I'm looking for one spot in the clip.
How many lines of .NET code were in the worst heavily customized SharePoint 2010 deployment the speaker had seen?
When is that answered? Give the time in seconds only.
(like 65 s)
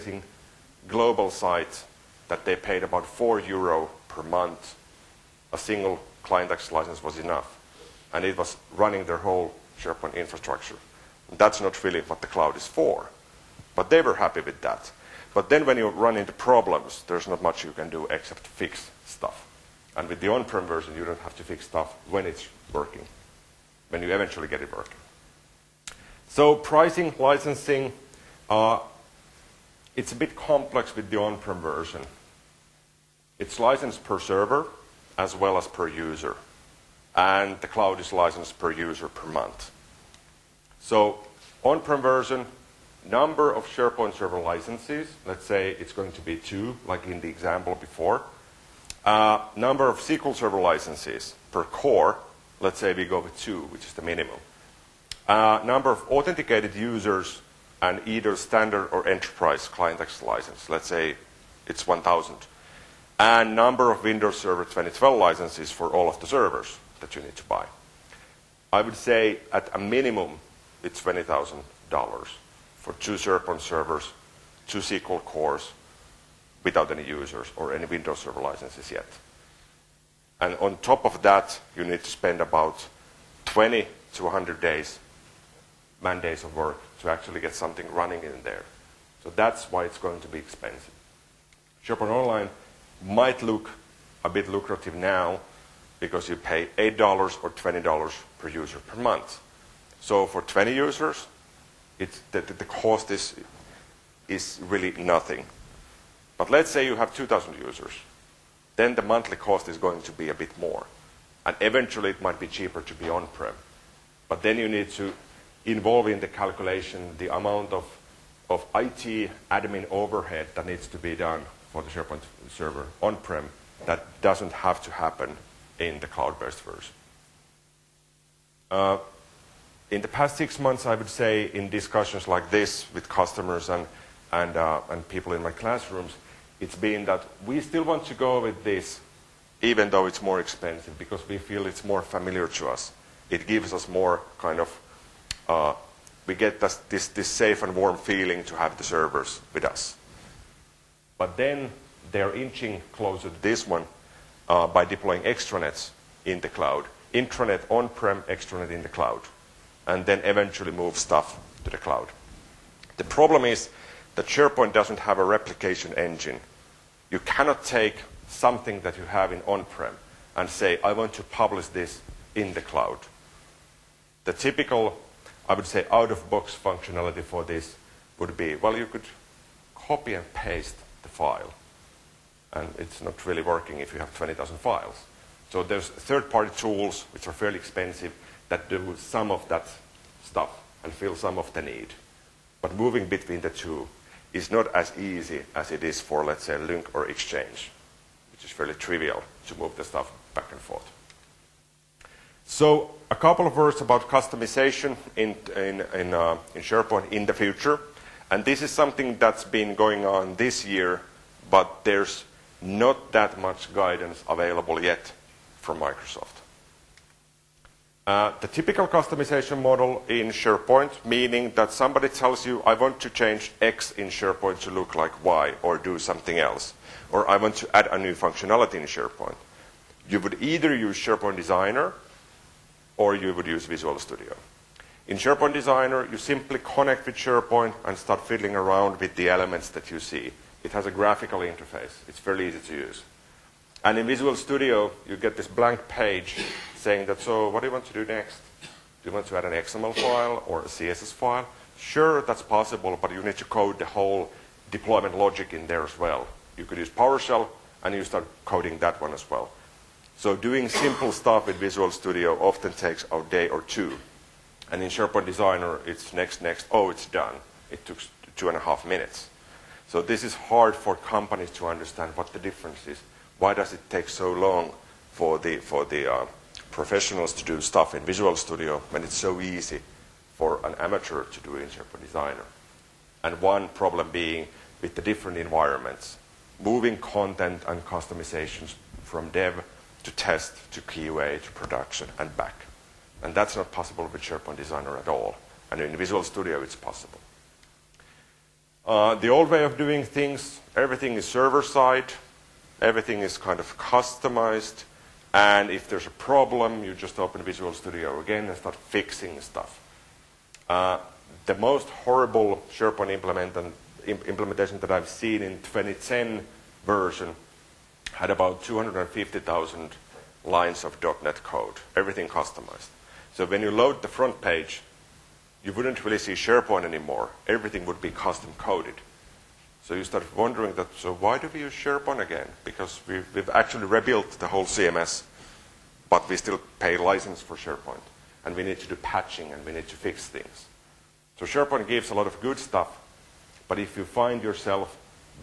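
318 s.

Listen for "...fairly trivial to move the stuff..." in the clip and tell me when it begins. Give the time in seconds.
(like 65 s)
198 s.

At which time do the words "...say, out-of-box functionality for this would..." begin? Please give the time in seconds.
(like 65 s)
175 s.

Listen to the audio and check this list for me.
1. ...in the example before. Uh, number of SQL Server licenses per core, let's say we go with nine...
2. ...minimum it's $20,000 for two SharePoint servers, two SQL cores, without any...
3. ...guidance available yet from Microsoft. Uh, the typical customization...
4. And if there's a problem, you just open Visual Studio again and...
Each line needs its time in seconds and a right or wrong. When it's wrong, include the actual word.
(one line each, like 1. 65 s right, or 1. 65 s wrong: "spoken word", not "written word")
1. 47 s wrong: "two", not "nine"
2. 69 s right
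3. 213 s right
4. 305 s right.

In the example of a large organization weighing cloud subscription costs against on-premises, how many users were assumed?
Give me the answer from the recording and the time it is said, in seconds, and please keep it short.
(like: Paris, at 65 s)
2,000, at 107 s.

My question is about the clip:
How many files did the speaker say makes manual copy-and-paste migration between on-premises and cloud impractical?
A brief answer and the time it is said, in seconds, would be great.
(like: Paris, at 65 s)
20,000, at 184 s.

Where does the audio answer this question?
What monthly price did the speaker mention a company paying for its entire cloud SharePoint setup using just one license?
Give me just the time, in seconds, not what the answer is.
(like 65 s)
3 s.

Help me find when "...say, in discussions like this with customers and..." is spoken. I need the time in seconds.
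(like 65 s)
131 s.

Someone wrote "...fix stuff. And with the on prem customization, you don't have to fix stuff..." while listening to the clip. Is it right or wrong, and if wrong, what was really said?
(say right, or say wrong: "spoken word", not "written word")
wrong: "version", not "customization".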